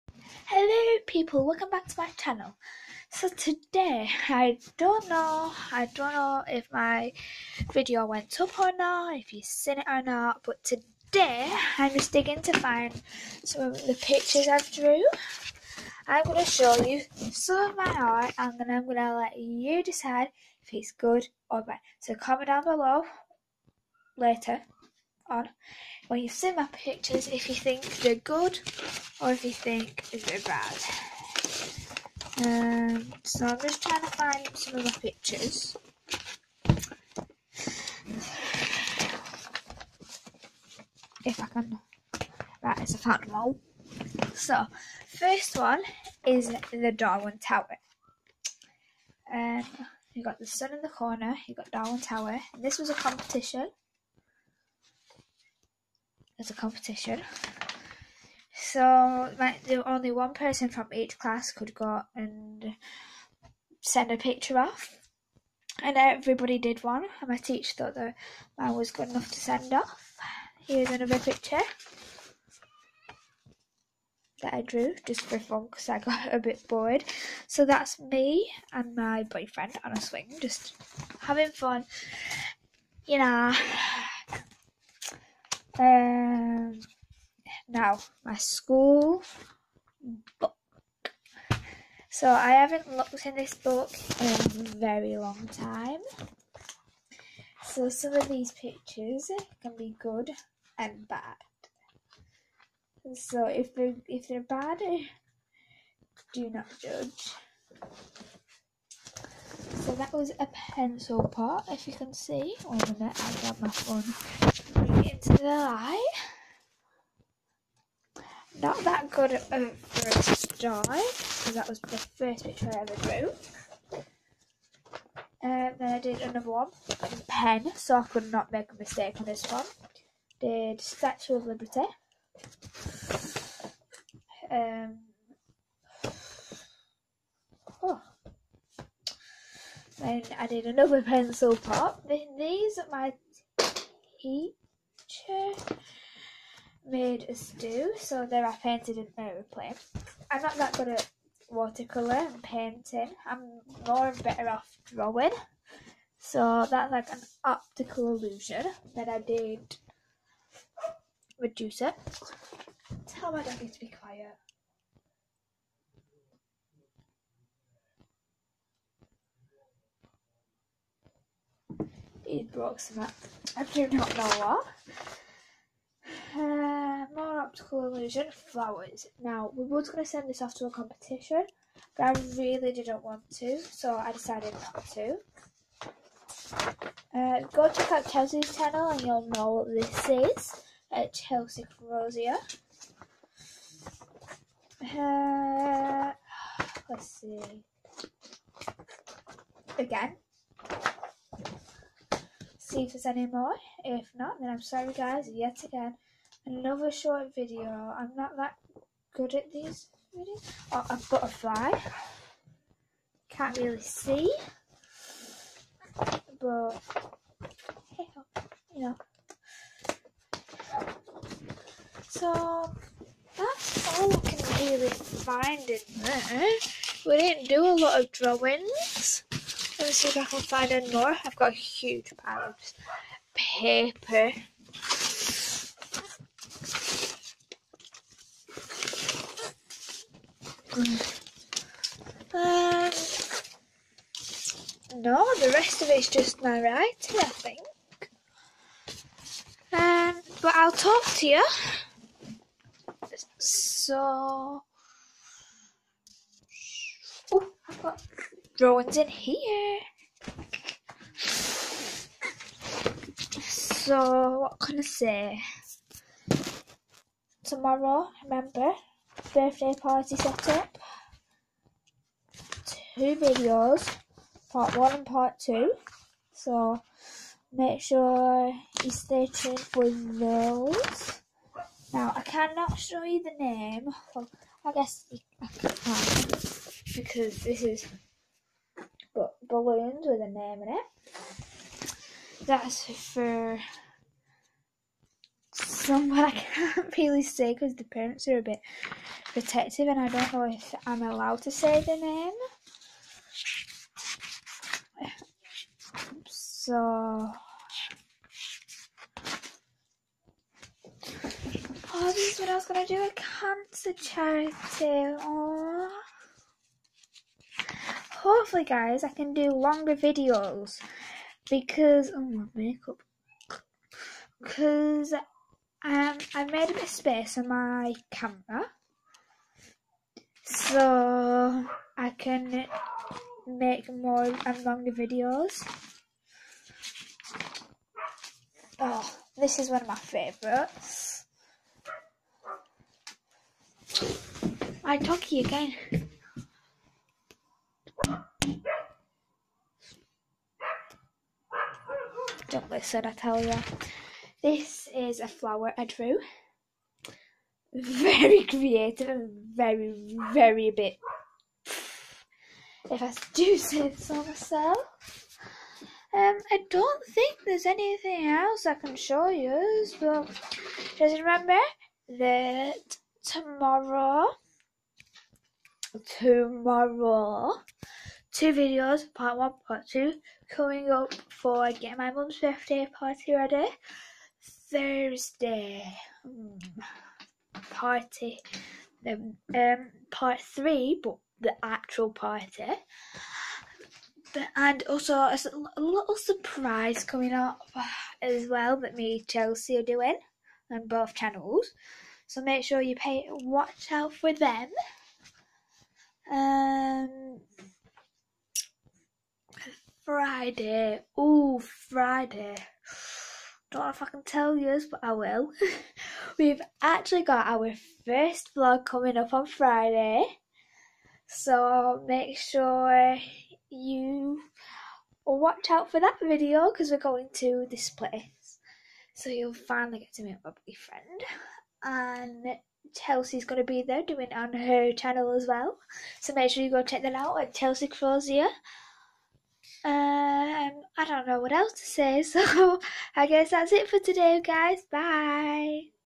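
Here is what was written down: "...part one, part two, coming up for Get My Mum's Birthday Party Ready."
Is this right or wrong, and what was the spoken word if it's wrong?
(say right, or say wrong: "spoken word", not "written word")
right.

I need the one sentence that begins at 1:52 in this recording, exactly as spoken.
One oh, minute, I got my phone into the eye.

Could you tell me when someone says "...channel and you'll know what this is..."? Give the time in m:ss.
3:08.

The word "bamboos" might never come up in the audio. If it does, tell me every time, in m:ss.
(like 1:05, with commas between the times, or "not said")
not said.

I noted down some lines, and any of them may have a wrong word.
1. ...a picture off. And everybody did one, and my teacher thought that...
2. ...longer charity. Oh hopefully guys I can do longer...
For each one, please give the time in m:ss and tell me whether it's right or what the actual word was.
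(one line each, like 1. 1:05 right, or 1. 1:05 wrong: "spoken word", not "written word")
1. 1:04 right
2. 5:13 wrong: "cancer", not "longer".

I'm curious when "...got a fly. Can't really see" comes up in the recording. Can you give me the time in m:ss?
3:31.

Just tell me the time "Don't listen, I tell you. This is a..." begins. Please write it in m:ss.
5:52.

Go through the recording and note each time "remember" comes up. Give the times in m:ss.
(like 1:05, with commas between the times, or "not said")
4:28, 6:11.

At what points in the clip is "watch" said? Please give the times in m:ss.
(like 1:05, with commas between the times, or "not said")
6:43, 7:05.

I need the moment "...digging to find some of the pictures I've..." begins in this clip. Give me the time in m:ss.
0:12.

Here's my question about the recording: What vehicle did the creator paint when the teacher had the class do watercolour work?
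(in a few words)
aeroplane.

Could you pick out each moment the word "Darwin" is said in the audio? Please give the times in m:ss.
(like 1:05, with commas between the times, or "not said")
0:46, 0:51.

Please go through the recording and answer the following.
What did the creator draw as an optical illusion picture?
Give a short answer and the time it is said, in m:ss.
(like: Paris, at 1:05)
flowers, at 2:57.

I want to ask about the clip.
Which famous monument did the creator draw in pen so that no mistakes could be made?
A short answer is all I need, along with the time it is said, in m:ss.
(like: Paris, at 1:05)
Statue of Liberty, at 2:10.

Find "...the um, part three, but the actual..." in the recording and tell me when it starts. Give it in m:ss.
6:29.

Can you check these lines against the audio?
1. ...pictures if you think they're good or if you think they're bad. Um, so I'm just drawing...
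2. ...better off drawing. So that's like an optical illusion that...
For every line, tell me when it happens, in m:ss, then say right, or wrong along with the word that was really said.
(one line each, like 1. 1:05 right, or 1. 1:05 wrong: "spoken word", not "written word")
1. 0:26 wrong: "trying", not "drawing"
2. 2:34 right.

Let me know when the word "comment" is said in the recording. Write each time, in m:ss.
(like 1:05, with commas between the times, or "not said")
0:22.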